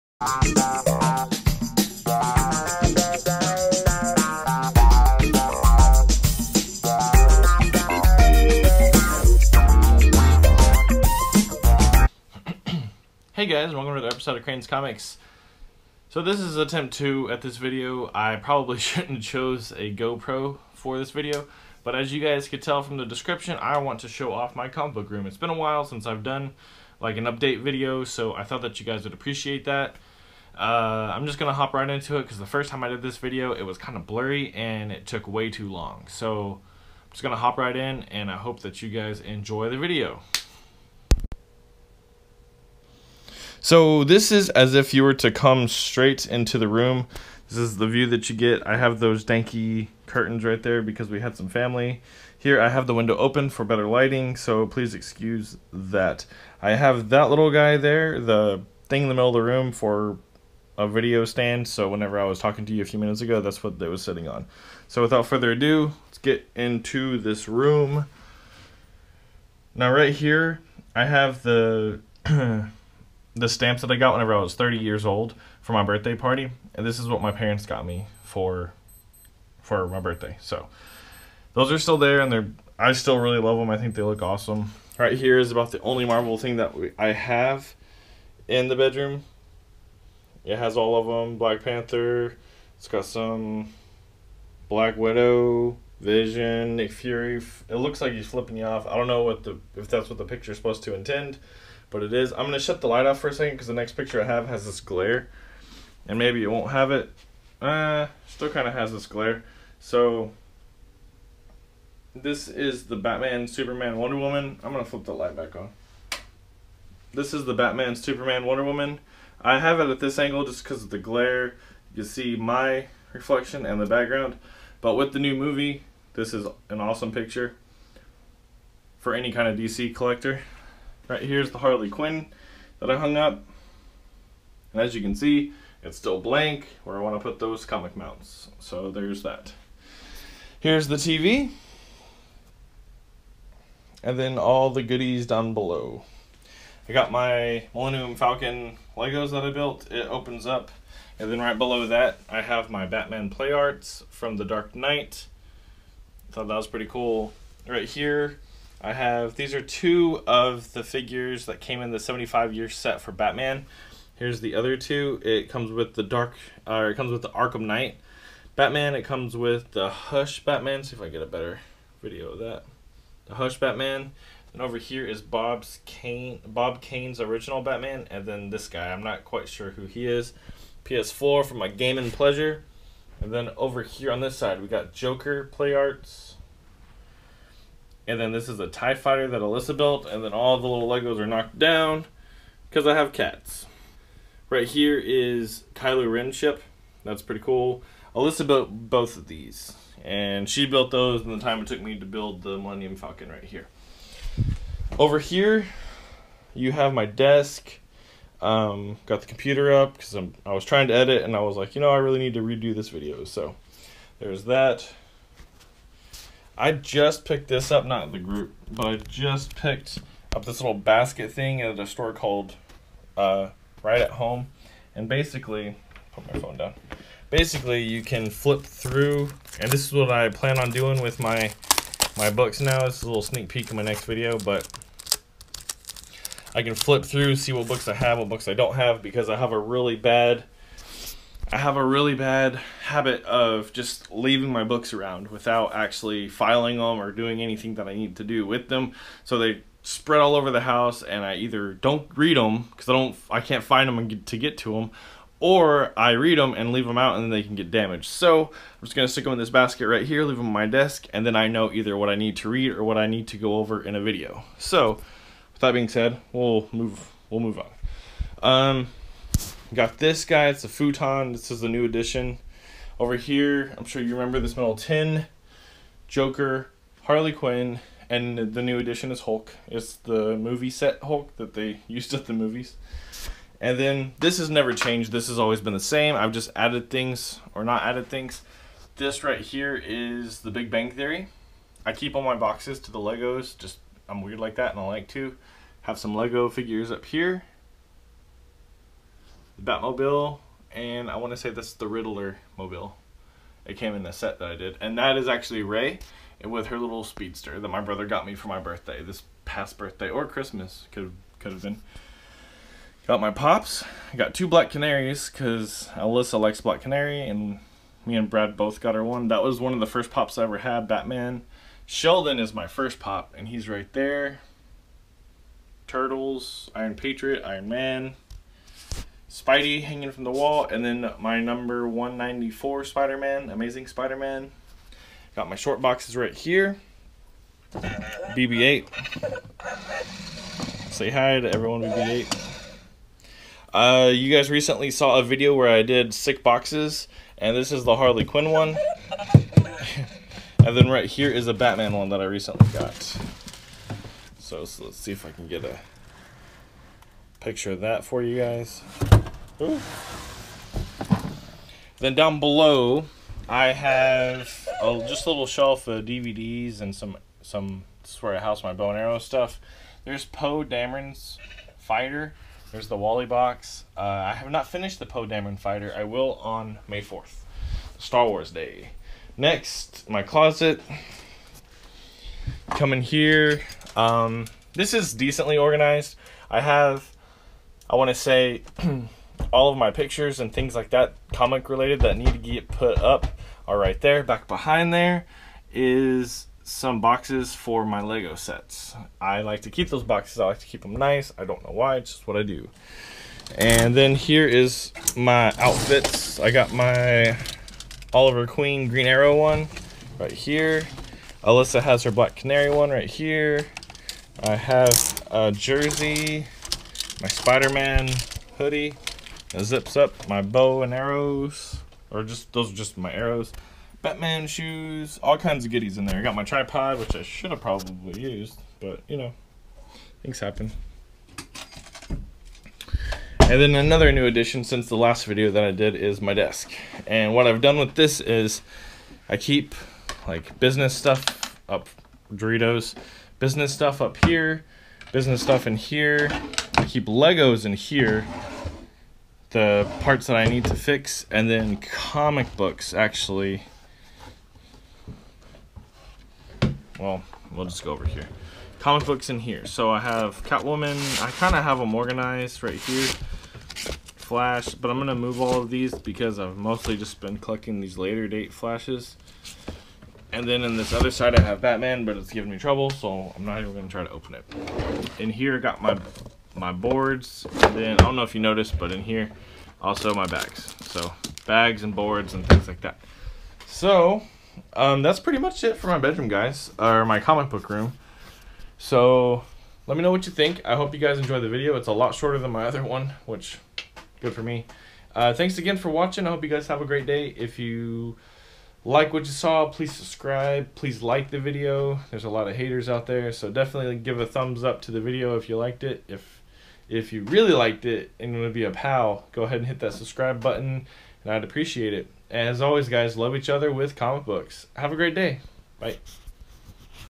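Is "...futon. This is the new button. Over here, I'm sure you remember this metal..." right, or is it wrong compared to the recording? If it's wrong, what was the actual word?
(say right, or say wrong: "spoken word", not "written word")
wrong: "edition", not "button".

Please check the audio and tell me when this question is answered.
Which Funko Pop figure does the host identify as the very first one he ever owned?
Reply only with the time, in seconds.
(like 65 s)
321 s.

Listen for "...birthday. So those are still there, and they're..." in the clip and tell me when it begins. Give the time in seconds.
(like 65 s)
79 s.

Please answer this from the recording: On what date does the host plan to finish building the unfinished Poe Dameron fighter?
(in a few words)
May 4th.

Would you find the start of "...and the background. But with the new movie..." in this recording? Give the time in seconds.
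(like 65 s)
123 s.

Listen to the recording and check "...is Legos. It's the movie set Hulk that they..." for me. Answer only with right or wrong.
wrong.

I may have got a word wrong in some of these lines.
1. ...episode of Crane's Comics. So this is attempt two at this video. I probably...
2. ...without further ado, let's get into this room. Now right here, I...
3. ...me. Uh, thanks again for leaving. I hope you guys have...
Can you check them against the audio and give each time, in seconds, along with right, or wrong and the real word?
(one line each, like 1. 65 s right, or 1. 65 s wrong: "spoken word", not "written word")
1. 14 s right
2. 65 s right
3. 494 s wrong: "watching", not "leaving".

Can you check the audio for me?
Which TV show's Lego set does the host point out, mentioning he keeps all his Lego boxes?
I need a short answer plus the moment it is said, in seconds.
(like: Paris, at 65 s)
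The Big Bang Theory, at 290 s.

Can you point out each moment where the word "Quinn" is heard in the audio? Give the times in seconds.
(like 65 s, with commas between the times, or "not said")
131 s, 277 s, 348 s.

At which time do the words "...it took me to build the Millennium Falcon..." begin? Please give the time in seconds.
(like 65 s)
201 s.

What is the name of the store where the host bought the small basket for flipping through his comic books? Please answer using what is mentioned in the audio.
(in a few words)
Right at Home.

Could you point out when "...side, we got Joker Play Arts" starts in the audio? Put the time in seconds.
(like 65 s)
184 s.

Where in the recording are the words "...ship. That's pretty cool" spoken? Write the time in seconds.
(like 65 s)
196 s.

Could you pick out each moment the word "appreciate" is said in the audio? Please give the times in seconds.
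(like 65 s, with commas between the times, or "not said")
29 s, 511 s.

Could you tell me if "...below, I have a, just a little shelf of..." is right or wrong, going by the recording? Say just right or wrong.
right.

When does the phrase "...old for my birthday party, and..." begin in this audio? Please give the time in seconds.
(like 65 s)
75 s.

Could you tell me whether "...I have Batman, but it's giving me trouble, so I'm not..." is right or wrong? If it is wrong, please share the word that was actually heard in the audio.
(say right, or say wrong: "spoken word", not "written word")
right.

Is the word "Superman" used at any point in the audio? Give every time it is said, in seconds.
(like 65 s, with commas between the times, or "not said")
113 s, 117 s.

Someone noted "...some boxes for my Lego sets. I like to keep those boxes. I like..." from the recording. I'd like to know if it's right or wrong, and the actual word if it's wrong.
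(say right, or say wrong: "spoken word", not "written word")
right.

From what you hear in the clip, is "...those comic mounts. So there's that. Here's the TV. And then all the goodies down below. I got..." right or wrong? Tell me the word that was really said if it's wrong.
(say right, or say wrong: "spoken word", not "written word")
right.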